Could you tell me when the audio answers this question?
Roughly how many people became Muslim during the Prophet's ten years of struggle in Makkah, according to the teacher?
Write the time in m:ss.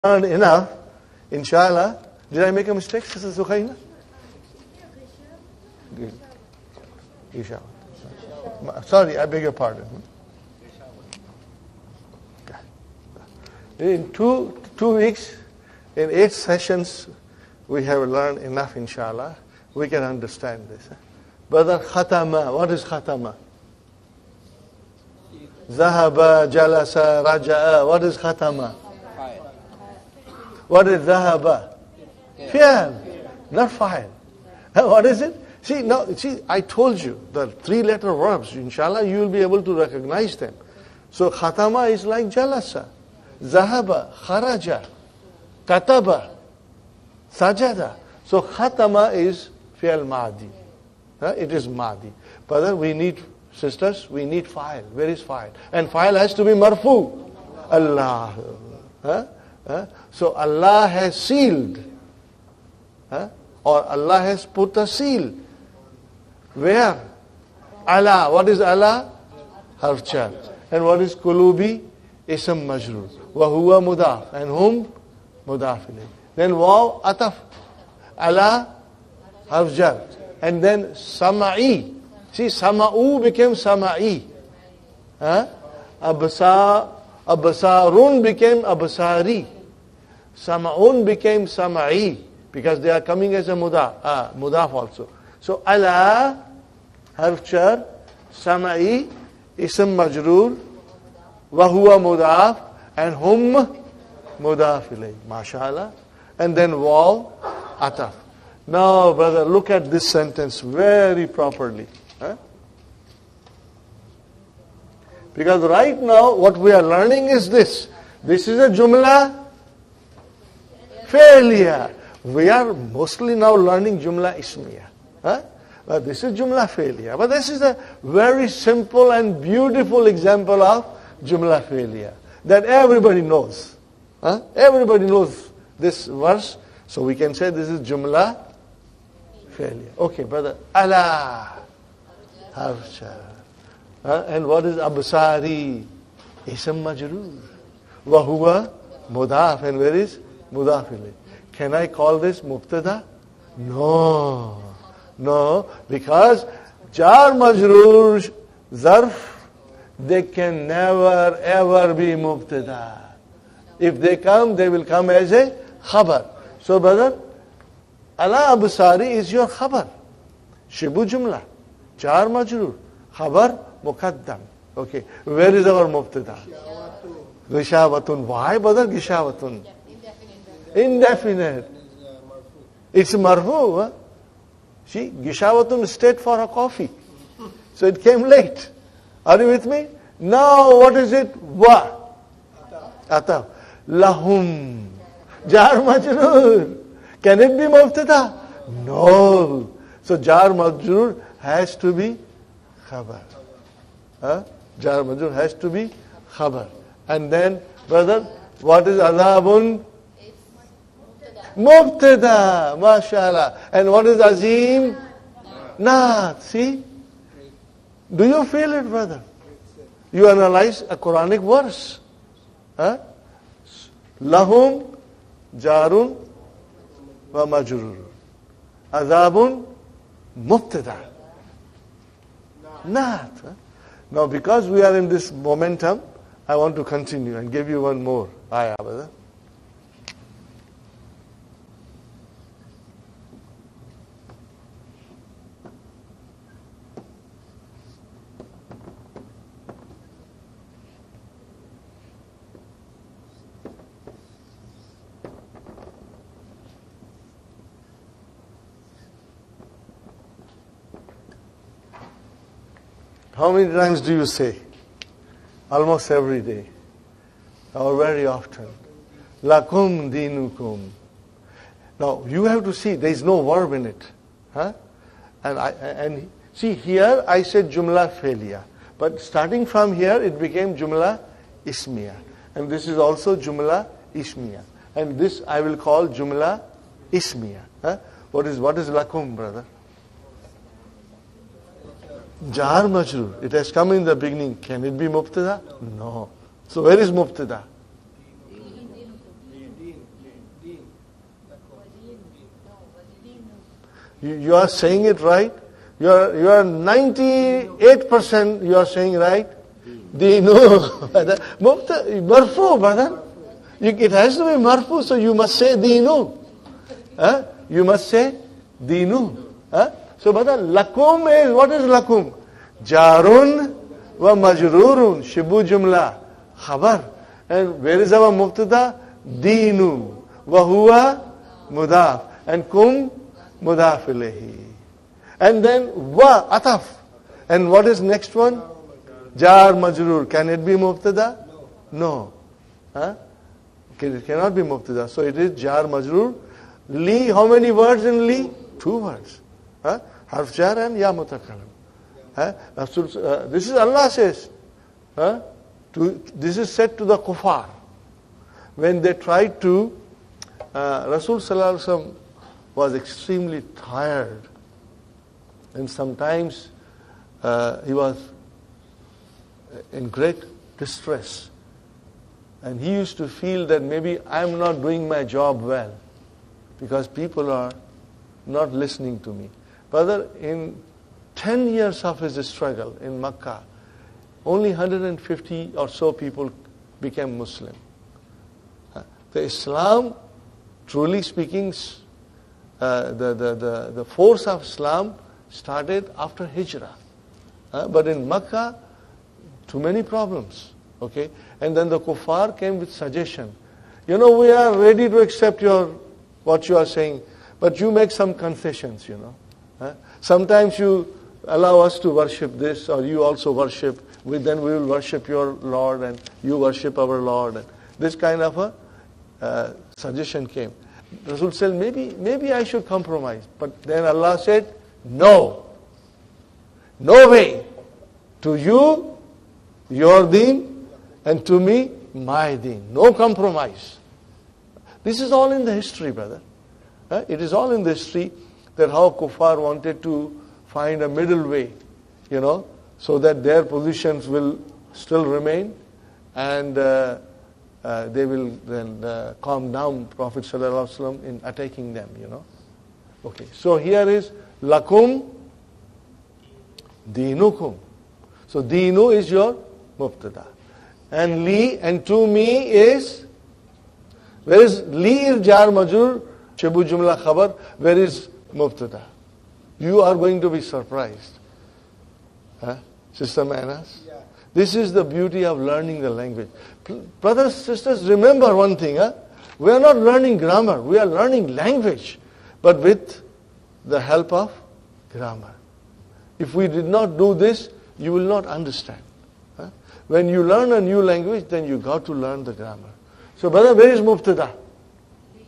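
6:24.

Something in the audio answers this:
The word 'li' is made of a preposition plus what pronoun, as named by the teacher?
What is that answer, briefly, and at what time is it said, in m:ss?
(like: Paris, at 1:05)
Ya mutakallim, at 5:50.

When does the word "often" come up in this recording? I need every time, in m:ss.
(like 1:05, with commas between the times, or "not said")
4:28.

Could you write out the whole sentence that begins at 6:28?
Uh, the Islam, truly speaking, uh, the, the, the, the force of Islam started after Hijrah.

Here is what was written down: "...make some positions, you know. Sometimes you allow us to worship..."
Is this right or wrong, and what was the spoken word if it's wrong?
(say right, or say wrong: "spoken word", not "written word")
wrong: "concessions", not "positions".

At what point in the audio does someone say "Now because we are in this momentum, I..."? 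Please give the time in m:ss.
3:54.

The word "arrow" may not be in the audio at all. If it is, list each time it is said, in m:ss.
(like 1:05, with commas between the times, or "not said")
not said.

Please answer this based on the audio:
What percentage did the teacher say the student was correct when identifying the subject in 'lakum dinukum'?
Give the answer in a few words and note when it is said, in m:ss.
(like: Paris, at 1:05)
98%, at 5:06.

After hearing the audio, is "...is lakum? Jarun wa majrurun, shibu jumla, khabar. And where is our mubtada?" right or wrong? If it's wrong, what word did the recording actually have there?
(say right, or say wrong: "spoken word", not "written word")
right.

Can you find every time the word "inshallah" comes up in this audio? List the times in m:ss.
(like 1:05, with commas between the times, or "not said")
0:01, 0:07, 0:18, 0:38.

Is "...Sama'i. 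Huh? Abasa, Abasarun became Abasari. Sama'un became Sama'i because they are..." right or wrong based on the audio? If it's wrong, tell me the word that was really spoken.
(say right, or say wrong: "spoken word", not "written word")
right.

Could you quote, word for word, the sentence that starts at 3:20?
So jar majrur has to be khabar.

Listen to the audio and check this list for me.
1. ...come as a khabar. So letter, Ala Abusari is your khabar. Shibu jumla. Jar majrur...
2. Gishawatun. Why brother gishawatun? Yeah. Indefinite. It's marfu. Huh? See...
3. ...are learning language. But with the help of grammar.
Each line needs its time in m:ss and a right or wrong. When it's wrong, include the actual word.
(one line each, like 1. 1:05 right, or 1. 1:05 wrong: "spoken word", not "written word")
1. 2:44 wrong: "brother", not "letter"
2. 2:57 right
3. 8:00 right.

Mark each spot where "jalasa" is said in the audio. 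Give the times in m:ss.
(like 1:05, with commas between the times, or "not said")
0:26, 0:42.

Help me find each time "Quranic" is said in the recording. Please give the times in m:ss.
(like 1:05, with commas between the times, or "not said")
3:40.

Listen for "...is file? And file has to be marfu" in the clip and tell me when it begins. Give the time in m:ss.
0:55.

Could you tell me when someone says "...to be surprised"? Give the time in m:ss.
7:50.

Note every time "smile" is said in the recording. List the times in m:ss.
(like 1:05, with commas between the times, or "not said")
not said.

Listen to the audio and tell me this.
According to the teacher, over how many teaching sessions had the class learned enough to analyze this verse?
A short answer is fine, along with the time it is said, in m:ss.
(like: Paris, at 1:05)
8, at 0:16.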